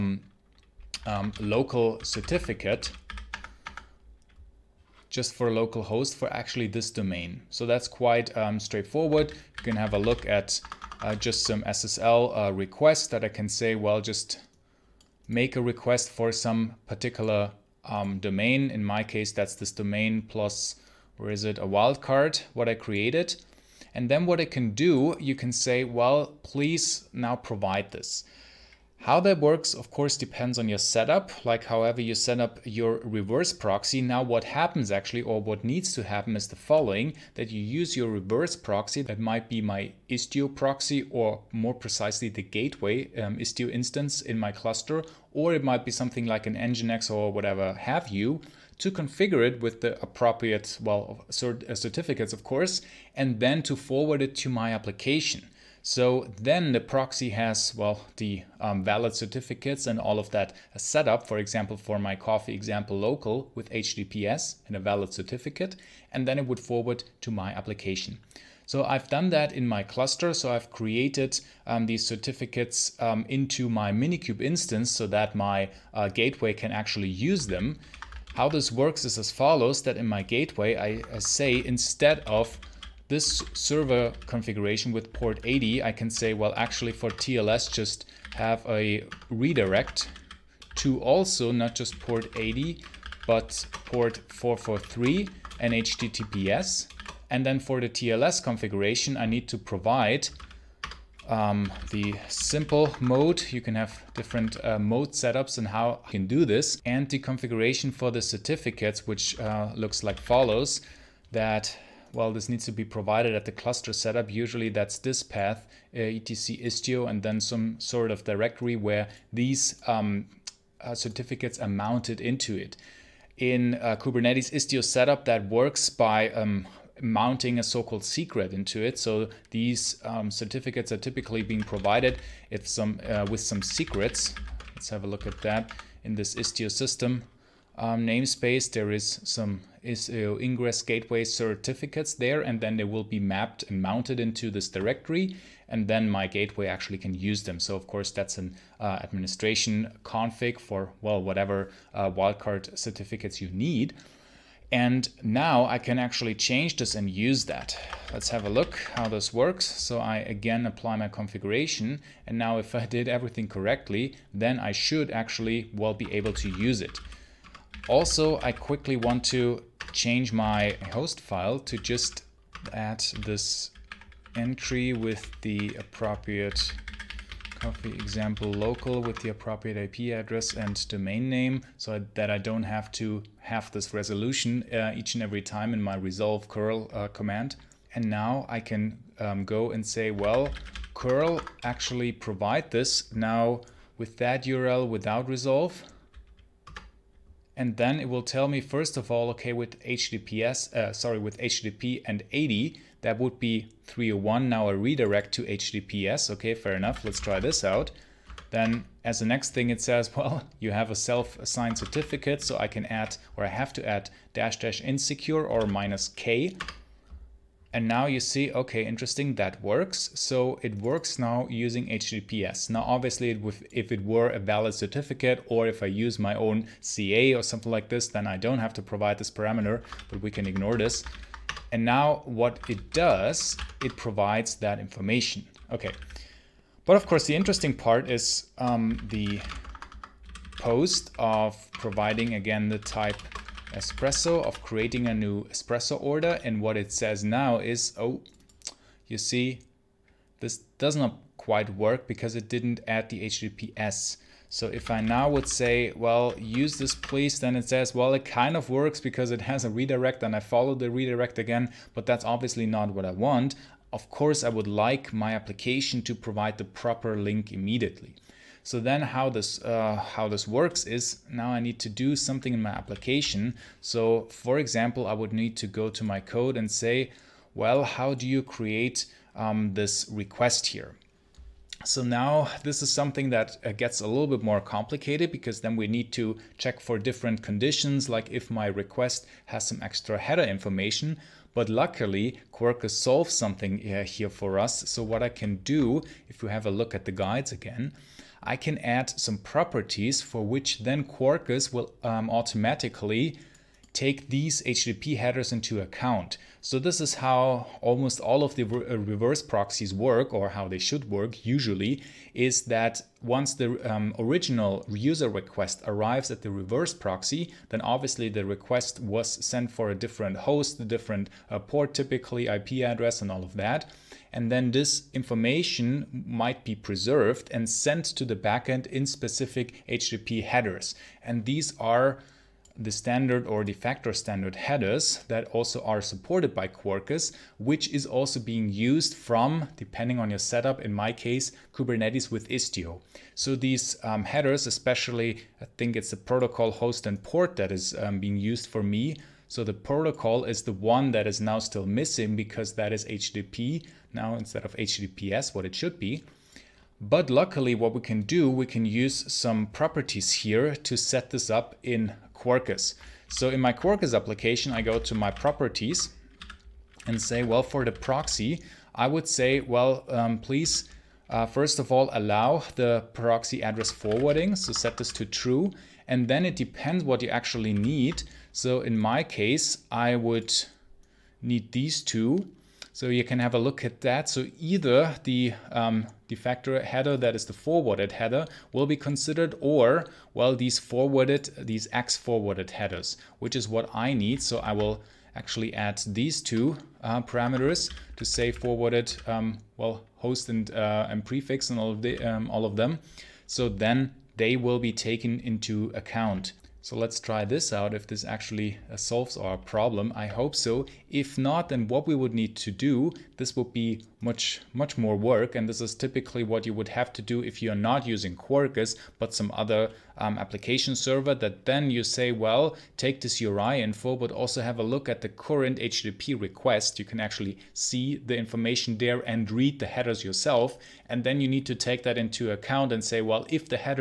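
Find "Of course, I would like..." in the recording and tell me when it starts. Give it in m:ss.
4:23.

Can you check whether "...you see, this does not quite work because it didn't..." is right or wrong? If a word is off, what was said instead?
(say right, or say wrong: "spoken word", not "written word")
right.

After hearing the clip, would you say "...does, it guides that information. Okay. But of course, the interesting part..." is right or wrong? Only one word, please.
wrong.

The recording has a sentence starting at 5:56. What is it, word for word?
But luckily what we can do, we can use some properties here to set this up in Quarkus.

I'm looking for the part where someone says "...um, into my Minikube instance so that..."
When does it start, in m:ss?
1:12.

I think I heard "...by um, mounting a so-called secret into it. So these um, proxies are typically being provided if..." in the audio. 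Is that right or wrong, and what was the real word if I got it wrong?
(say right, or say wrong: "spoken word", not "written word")
wrong: "certificates", not "proxies".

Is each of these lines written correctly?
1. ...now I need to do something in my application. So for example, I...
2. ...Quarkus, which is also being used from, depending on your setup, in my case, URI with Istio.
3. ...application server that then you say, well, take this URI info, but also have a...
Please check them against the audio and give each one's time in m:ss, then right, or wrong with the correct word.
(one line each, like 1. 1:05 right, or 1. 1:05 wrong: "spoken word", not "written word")
1. 4:31 right
2. 5:36 wrong: "Kubernetes", not "URI"
3. 7:00 right.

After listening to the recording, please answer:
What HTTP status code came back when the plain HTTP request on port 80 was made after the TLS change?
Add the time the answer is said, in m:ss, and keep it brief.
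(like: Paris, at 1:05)
301, at 3:23.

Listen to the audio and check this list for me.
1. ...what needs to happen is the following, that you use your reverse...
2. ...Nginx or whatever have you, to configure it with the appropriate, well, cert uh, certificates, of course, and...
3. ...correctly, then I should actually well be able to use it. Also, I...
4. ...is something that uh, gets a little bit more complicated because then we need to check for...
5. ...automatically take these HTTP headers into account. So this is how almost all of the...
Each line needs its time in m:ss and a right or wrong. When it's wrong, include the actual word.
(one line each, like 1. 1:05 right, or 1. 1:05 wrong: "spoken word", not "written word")
1. 0:35 right
2. 0:46 right
3. 2:43 right
4. 4:42 right
5. 5:02 right.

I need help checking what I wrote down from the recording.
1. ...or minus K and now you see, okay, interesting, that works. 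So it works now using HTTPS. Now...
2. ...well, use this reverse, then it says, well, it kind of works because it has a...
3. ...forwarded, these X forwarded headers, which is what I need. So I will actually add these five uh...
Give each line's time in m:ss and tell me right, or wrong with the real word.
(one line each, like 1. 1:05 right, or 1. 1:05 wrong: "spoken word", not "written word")
1. 3:35 right
2. 4:15 wrong: "please", not "reverse"
3. 6:30 wrong: "two", not "five".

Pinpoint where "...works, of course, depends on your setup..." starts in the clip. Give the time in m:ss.
0:29.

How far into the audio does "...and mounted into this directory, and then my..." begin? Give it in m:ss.
2:23.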